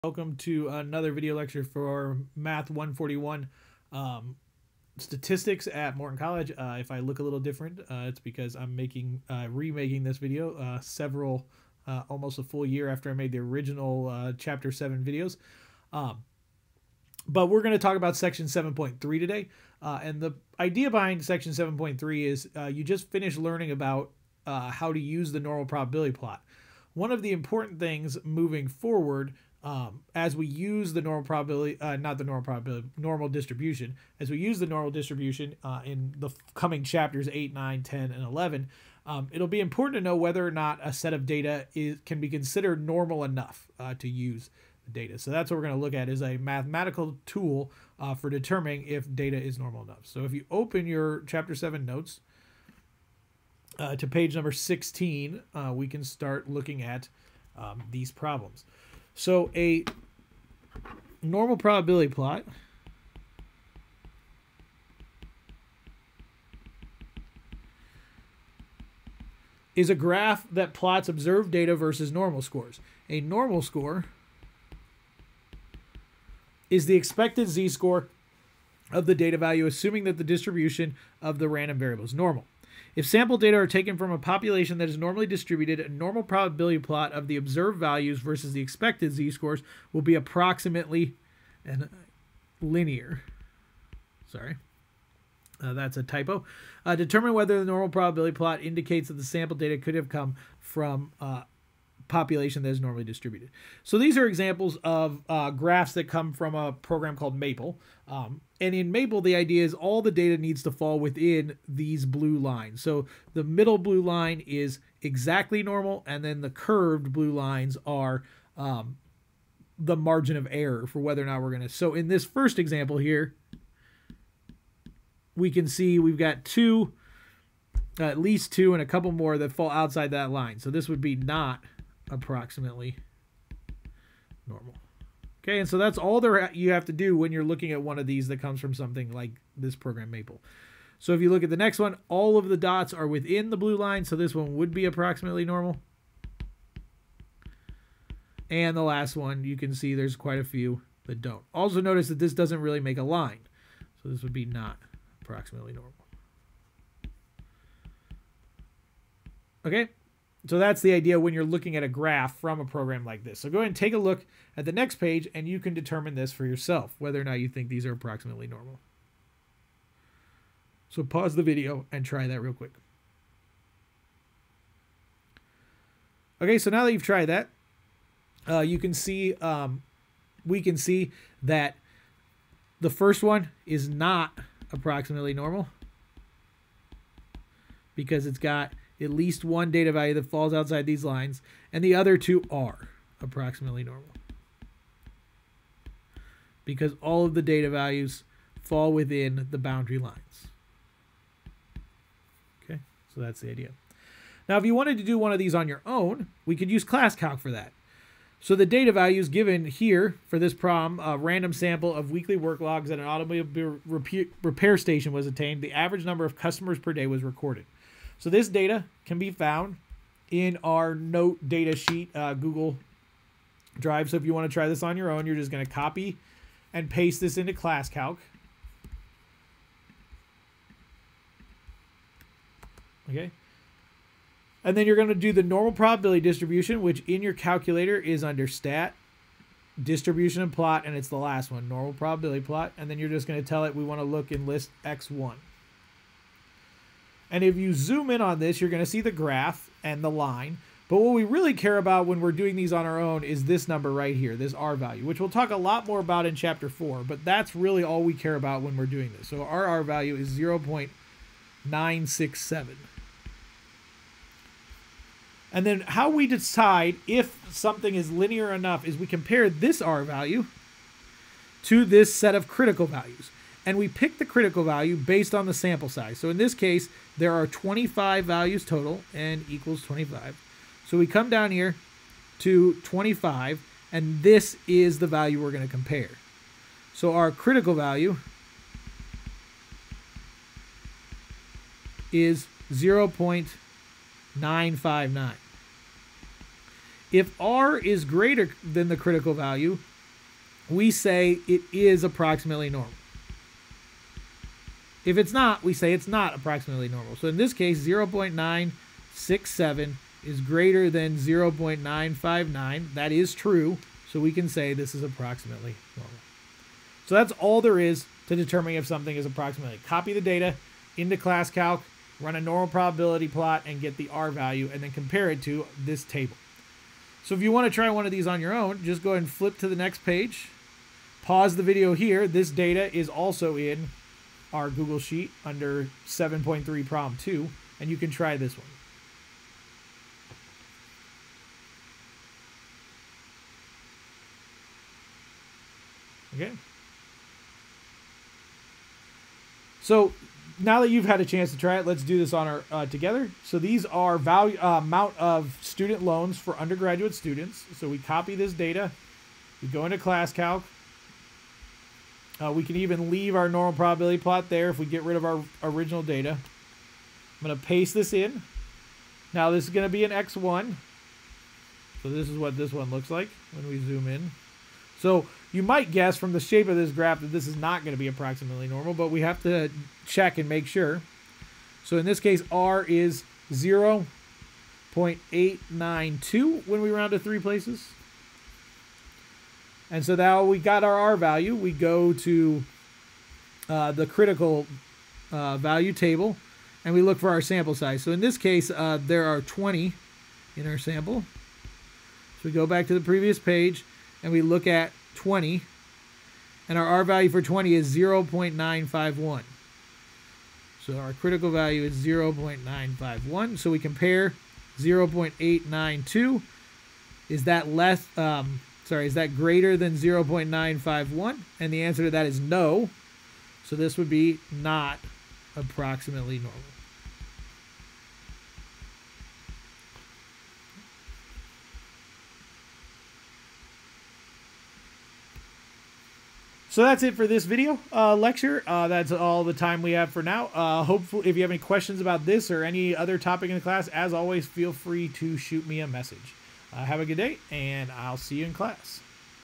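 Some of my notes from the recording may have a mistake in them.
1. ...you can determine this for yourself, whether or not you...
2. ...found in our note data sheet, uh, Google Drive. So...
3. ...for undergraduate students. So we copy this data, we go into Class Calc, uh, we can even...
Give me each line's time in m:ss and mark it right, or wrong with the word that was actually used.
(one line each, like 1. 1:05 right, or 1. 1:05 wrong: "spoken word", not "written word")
1. 2:45 right
2. 3:39 right
3. 5:56 right.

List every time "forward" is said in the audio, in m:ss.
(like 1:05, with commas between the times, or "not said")
0:28.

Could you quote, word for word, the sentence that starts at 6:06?
I'm going to paste this in.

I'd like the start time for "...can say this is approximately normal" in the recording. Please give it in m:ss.
5:14.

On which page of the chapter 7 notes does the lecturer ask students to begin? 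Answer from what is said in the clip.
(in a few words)
16.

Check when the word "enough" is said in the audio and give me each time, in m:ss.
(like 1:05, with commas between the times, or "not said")
0:43, 0:49, 4:28.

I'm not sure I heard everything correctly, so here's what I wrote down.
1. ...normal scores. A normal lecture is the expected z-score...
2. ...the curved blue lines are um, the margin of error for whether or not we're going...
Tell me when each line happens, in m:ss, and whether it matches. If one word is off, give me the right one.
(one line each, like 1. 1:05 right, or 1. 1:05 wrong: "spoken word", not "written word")
1. 1:12 wrong: "score", not "lecture"
2. 1:56 right.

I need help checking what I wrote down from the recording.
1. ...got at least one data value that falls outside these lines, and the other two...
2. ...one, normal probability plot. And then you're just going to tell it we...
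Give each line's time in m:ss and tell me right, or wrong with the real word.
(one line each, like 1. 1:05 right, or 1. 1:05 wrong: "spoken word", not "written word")
1. 3:08 right
2. 4:01 right.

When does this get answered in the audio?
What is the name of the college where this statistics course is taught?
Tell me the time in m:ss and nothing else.
0:05.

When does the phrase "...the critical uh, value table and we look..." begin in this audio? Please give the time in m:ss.
6:33.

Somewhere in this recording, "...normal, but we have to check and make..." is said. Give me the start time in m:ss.
6:18.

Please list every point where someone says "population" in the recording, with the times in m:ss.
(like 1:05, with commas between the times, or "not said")
1:24, 1:42.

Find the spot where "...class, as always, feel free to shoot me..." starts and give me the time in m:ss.
7:23.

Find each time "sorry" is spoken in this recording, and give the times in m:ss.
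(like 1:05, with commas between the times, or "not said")
1:34, 6:58.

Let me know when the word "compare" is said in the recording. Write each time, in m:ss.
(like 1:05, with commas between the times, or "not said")
4:29, 4:45, 5:24, 6:53.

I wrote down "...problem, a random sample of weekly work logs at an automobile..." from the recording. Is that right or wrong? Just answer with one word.
right.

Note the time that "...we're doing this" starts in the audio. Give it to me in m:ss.
4:18.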